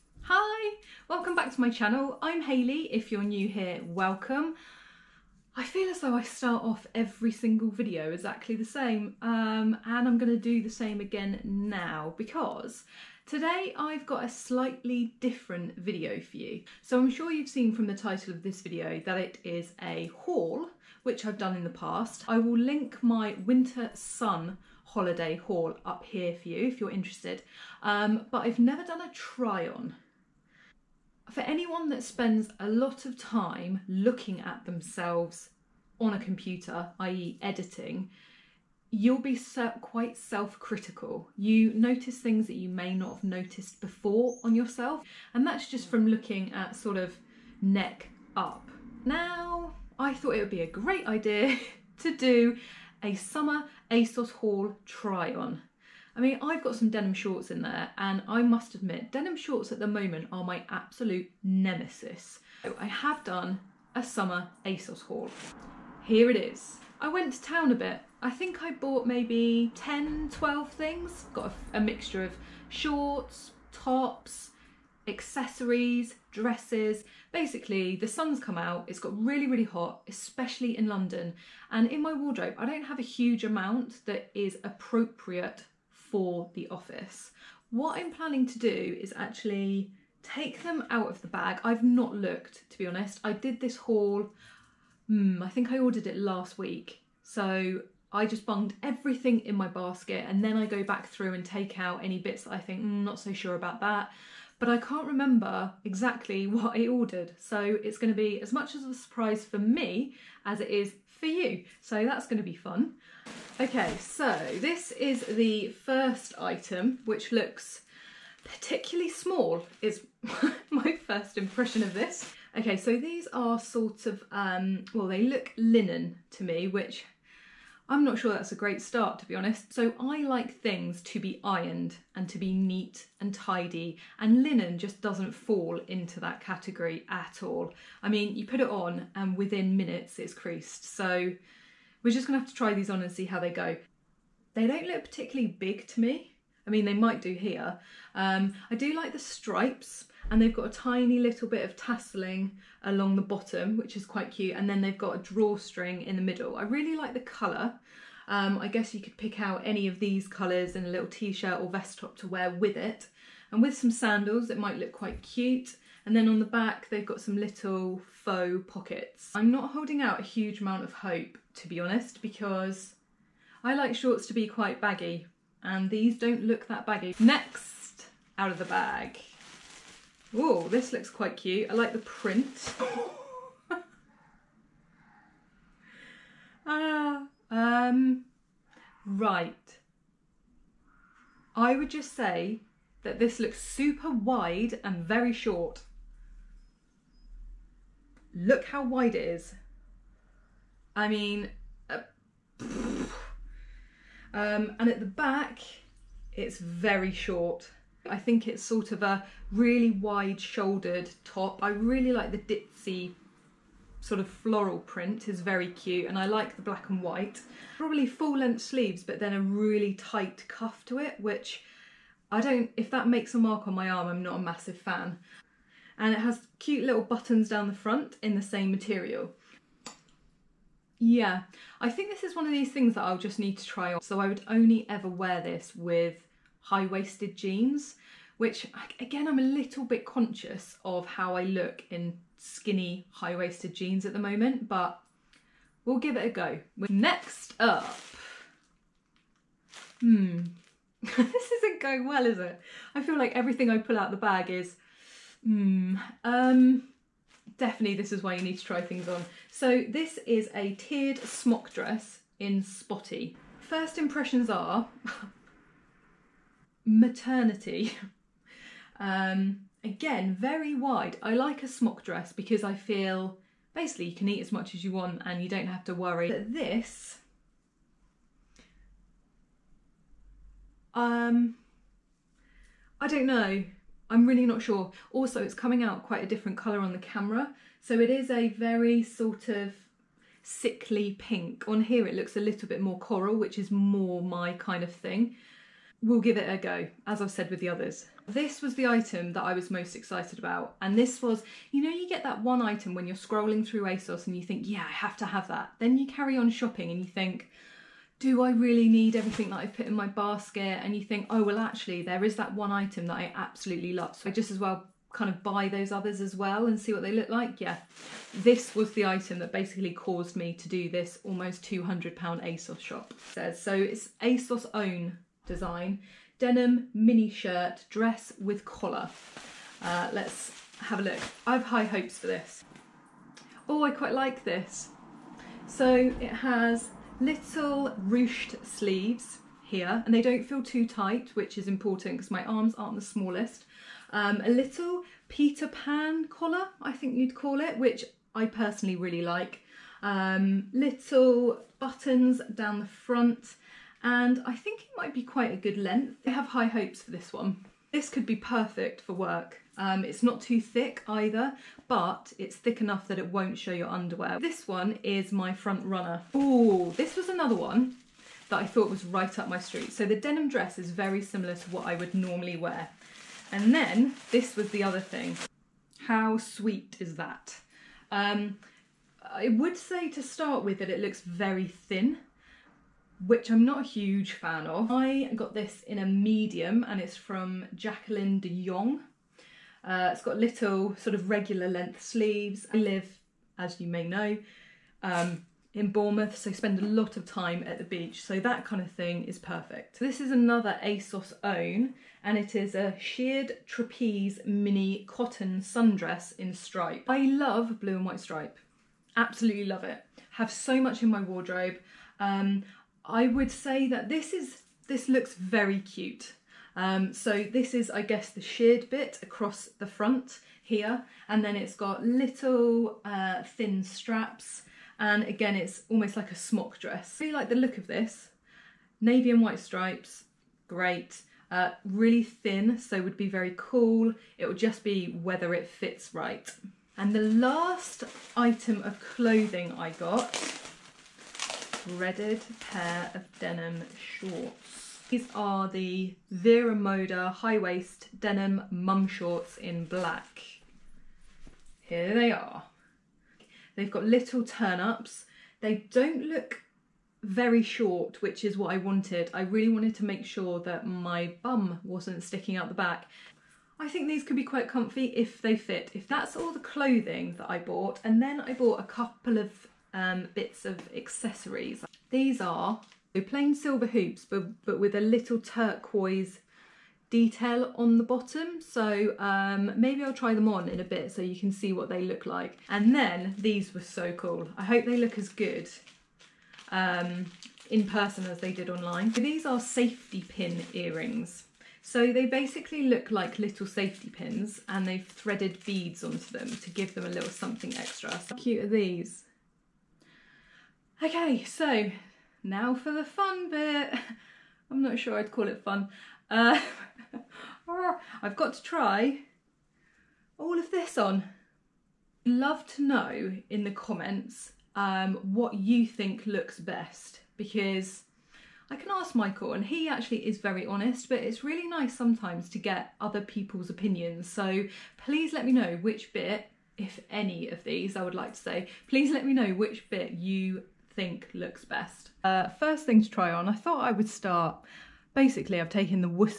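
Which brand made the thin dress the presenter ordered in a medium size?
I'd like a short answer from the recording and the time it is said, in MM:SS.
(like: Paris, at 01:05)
Jacqueline de Yong, at 06:27.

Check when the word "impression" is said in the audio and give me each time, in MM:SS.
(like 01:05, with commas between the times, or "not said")
02:01, 04:23.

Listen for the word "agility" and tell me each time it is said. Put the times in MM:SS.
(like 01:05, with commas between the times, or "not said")
not said.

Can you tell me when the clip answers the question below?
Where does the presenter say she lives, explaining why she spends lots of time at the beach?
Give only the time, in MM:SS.
06:35.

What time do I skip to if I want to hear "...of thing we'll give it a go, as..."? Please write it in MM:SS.
04:54.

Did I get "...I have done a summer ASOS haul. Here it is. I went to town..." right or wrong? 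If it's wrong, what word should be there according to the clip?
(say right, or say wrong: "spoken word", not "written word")
right.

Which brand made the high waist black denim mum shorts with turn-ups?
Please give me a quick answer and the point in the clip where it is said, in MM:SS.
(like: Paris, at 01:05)
Vero Moda, at 07:26.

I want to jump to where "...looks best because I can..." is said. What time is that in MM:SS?
08:36.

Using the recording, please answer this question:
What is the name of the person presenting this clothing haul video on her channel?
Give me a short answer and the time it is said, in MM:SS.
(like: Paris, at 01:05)
Hayley, at 00:02.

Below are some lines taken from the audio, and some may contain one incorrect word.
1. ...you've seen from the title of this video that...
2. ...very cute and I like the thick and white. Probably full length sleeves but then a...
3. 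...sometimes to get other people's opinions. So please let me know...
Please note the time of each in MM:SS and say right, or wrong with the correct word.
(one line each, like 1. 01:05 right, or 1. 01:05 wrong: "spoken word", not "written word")
1. 00:17 right
2. 03:35 wrong: "black", not "thick"
3. 08:41 right.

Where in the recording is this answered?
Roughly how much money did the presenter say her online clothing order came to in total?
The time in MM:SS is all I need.
05:21.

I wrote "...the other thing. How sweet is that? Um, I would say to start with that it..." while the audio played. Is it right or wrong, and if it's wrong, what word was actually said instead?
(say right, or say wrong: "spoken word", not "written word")
right.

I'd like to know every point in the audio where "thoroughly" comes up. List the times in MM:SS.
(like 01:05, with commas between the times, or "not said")
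not said.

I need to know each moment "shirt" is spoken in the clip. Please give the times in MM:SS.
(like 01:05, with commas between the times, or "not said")
02:41, 05:27.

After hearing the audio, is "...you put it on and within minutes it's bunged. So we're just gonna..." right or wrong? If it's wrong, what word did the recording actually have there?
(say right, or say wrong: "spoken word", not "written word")
wrong: "creased", not "bunged".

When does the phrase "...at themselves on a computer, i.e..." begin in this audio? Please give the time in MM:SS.
00:34.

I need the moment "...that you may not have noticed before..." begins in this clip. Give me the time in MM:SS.
00:42.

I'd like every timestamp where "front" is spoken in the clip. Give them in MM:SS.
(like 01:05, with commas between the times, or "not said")
03:47, 05:52, 06:05, 06:59.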